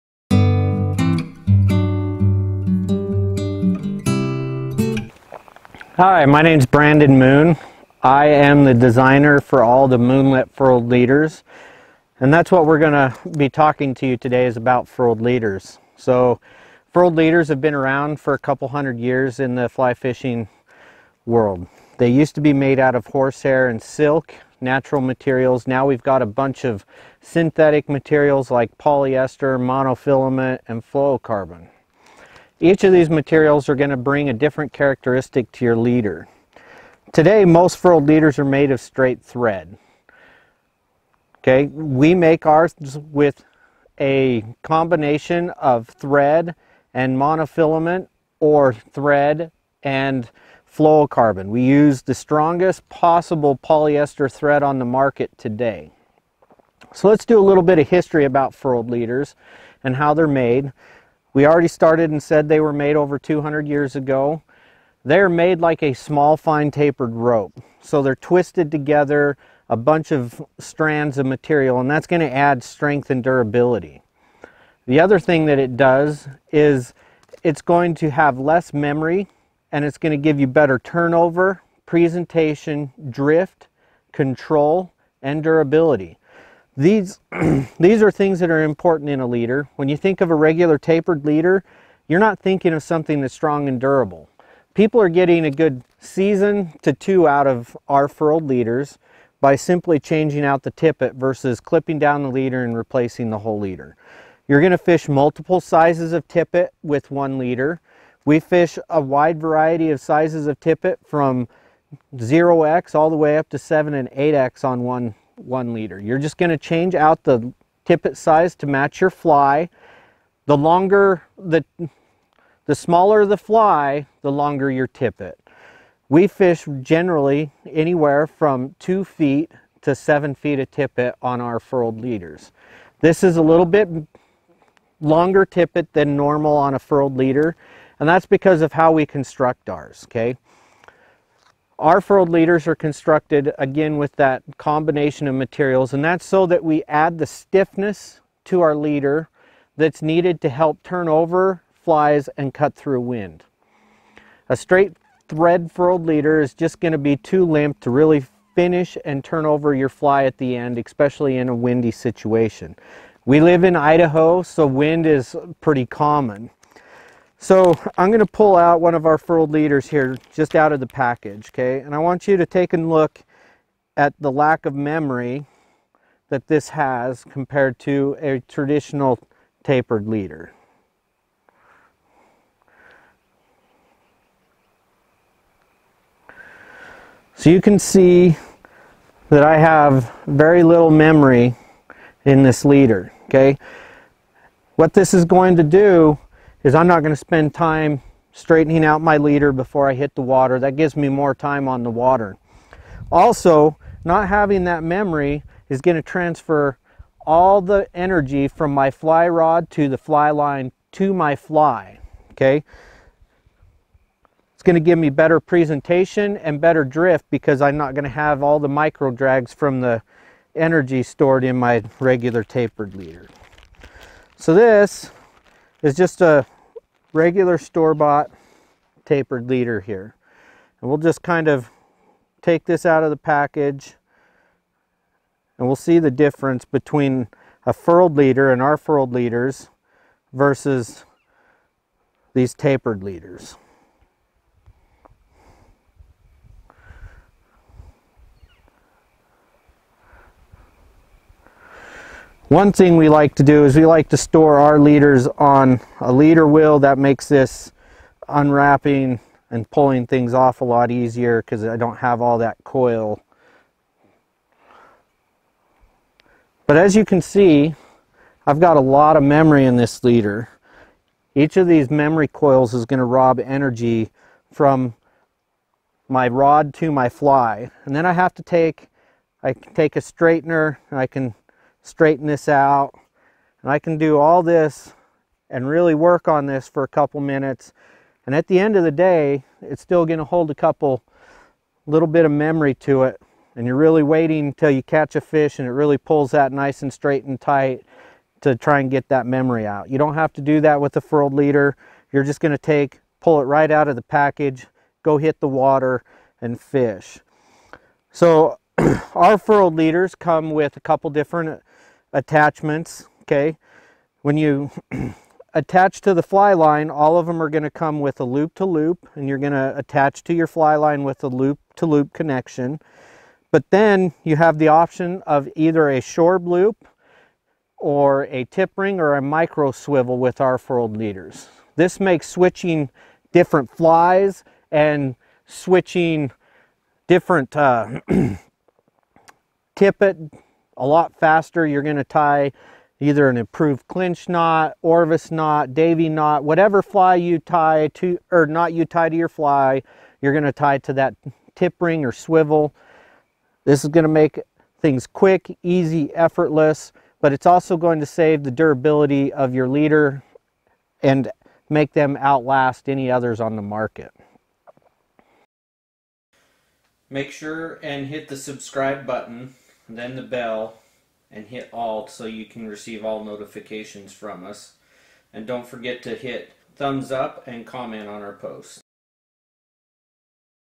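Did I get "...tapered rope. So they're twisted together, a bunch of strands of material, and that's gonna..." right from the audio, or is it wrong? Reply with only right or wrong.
right.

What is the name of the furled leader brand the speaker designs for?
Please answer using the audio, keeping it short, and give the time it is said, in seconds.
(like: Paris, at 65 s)
Moonlit, at 9 s.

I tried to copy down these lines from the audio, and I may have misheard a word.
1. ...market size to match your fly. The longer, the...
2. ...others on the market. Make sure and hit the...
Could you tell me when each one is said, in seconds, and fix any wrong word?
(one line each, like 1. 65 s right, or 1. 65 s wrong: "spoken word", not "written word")
1. 117 s wrong: "tippet", not "market"
2. 363 s right.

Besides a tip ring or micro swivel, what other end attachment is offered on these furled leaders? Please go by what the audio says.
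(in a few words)
Shorb loop.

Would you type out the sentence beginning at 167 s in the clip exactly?
So I'm going to pull out one of our furled leaders here just out of the package, okay?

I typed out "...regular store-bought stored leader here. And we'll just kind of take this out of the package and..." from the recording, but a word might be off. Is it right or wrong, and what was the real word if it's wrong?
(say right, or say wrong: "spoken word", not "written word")
wrong: "tapered", not "stored".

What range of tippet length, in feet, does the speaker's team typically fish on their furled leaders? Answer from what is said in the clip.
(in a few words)
2 to 7 feet.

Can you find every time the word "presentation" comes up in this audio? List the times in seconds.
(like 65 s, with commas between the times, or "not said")
81 s, 215 s.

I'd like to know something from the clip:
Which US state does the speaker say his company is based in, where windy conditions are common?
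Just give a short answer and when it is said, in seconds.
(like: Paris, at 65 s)
Idaho, at 163 s.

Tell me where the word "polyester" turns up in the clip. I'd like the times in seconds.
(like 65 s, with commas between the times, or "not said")
28 s, 53 s.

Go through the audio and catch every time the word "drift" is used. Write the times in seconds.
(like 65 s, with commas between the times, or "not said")
83 s, 216 s.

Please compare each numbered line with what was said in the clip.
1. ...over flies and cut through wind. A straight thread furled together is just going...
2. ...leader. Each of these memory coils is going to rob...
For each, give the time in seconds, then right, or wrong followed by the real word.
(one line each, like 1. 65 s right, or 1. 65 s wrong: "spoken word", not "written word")
1. 151 s wrong: "leader", not "together"
2. 270 s right.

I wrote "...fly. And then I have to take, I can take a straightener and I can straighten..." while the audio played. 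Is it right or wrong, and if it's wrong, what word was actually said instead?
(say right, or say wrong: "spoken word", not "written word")
right.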